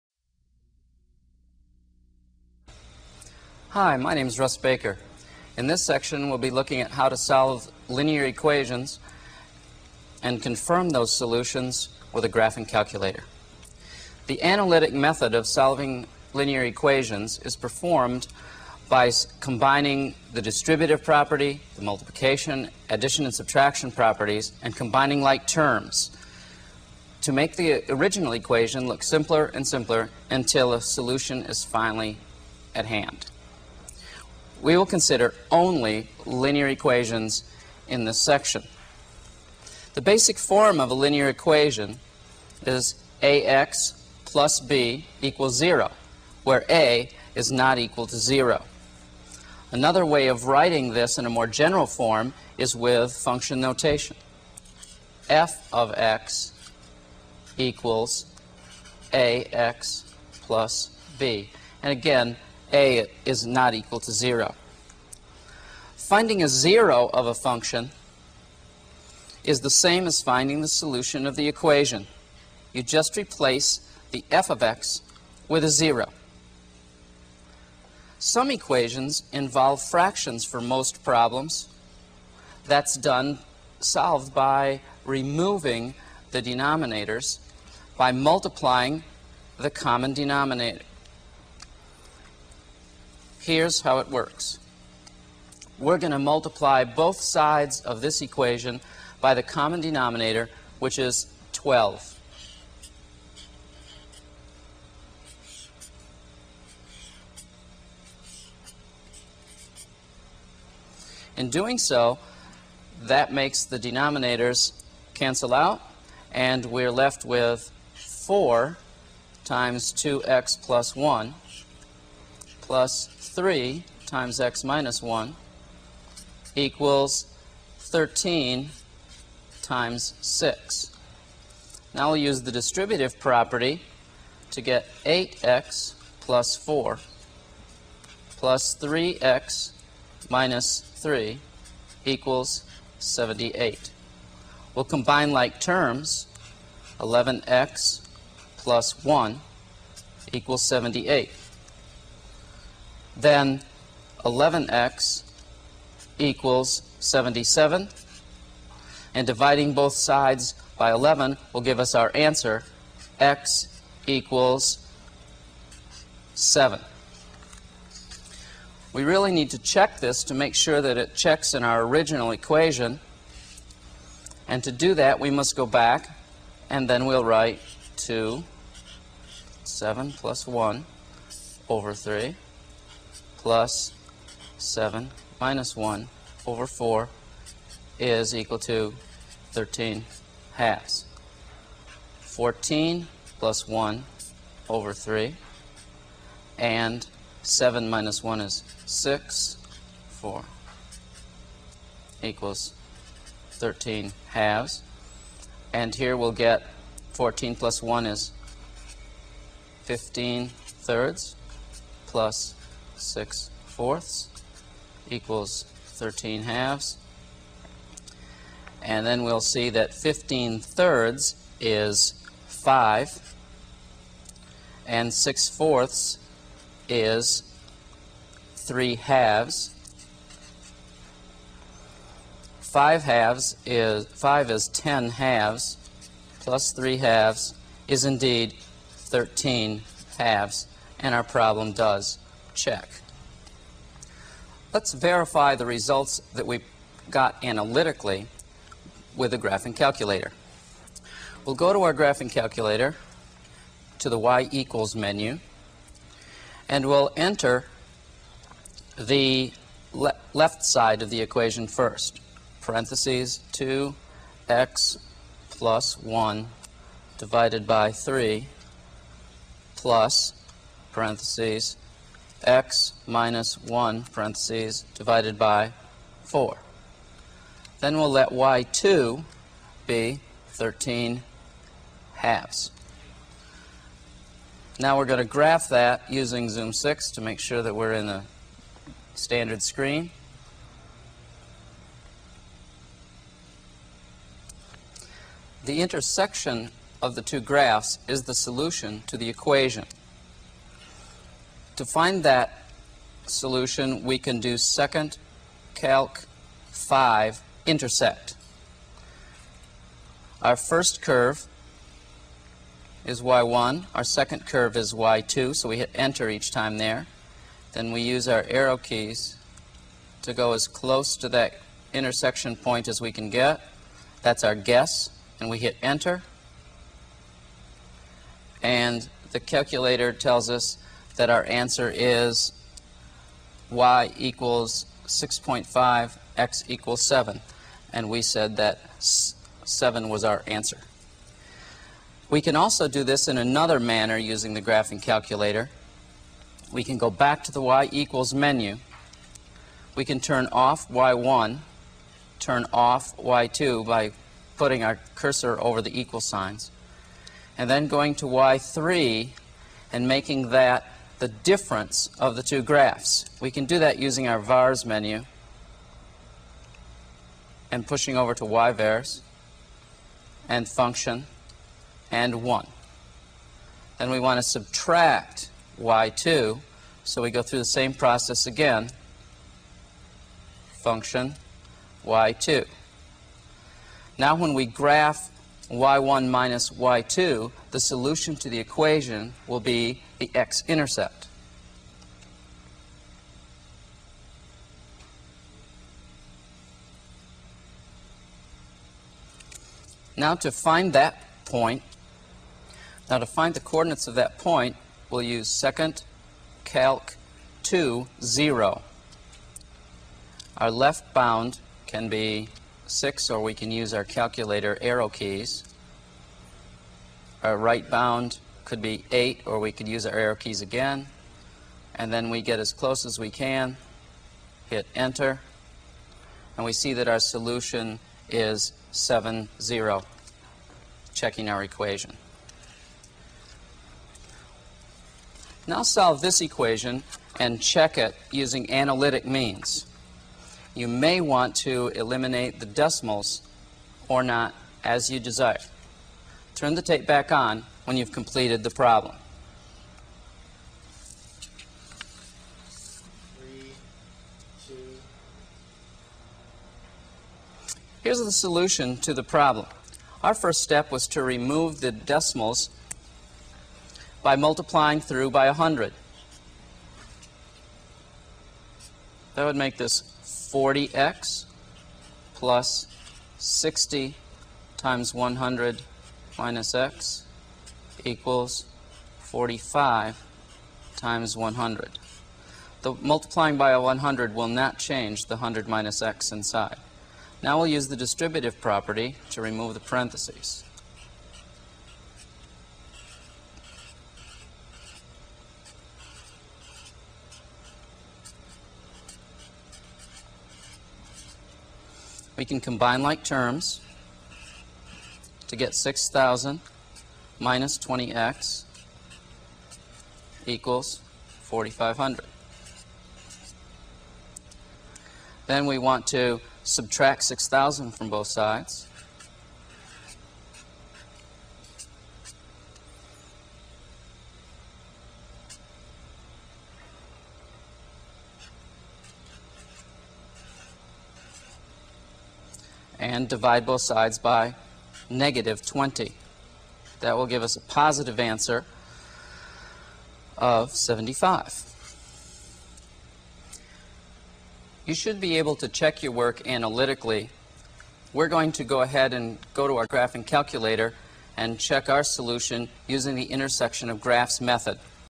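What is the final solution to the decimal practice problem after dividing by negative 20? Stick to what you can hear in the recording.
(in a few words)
75.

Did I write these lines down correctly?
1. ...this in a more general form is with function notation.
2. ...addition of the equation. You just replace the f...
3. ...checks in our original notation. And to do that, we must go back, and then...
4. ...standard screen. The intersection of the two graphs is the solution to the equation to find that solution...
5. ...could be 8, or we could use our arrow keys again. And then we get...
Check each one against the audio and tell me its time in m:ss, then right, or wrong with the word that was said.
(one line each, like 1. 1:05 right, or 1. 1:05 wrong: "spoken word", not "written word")
1. 0:50 right
2. 1:10 wrong: "solution", not "addition"
3. 2:51 wrong: "equation", not "notation"
4. 4:49 right
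5. 6:58 right.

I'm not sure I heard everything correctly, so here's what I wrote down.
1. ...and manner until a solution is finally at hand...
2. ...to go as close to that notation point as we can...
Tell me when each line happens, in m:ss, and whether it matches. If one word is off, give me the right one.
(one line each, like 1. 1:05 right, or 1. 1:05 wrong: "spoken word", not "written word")
1. 0:29 wrong: "simpler", not "manner"
2. 5:20 wrong: "intersection", not "notation".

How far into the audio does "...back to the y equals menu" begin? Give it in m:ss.
5:47.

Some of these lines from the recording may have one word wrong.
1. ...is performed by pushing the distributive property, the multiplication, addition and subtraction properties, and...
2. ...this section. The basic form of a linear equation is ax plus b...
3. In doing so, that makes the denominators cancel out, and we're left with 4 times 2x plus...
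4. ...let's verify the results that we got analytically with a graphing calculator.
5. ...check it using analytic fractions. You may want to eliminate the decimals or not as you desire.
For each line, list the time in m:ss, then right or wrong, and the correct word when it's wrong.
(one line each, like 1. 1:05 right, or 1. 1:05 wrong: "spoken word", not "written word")
1. 0:17 wrong: "combining", not "pushing"
2. 0:38 right
3. 1:51 right
4. 4:04 right
5. 7:17 wrong: "means", not "fractions".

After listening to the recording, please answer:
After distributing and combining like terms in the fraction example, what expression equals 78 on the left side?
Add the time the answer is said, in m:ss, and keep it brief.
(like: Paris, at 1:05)
11x plus 1, at 2:26.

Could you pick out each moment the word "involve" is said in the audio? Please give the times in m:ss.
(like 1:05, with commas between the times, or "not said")
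1:19.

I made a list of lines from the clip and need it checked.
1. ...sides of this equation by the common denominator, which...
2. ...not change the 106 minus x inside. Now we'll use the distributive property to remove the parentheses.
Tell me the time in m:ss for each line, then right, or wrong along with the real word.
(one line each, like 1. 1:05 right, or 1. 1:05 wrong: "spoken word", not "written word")
1. 1:37 right
2. 8:04 wrong: "100", not "106".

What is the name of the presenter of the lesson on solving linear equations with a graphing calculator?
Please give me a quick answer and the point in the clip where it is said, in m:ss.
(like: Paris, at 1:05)
Russ Baker, at 0:04.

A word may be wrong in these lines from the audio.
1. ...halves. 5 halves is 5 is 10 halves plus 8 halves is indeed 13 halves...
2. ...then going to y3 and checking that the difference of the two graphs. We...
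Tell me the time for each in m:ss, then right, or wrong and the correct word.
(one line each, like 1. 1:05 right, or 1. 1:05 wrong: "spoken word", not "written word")
1. 3:48 wrong: "3", not "8"
2. 5:57 wrong: "making", not "checking".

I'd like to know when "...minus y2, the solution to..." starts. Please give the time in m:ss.
6:26.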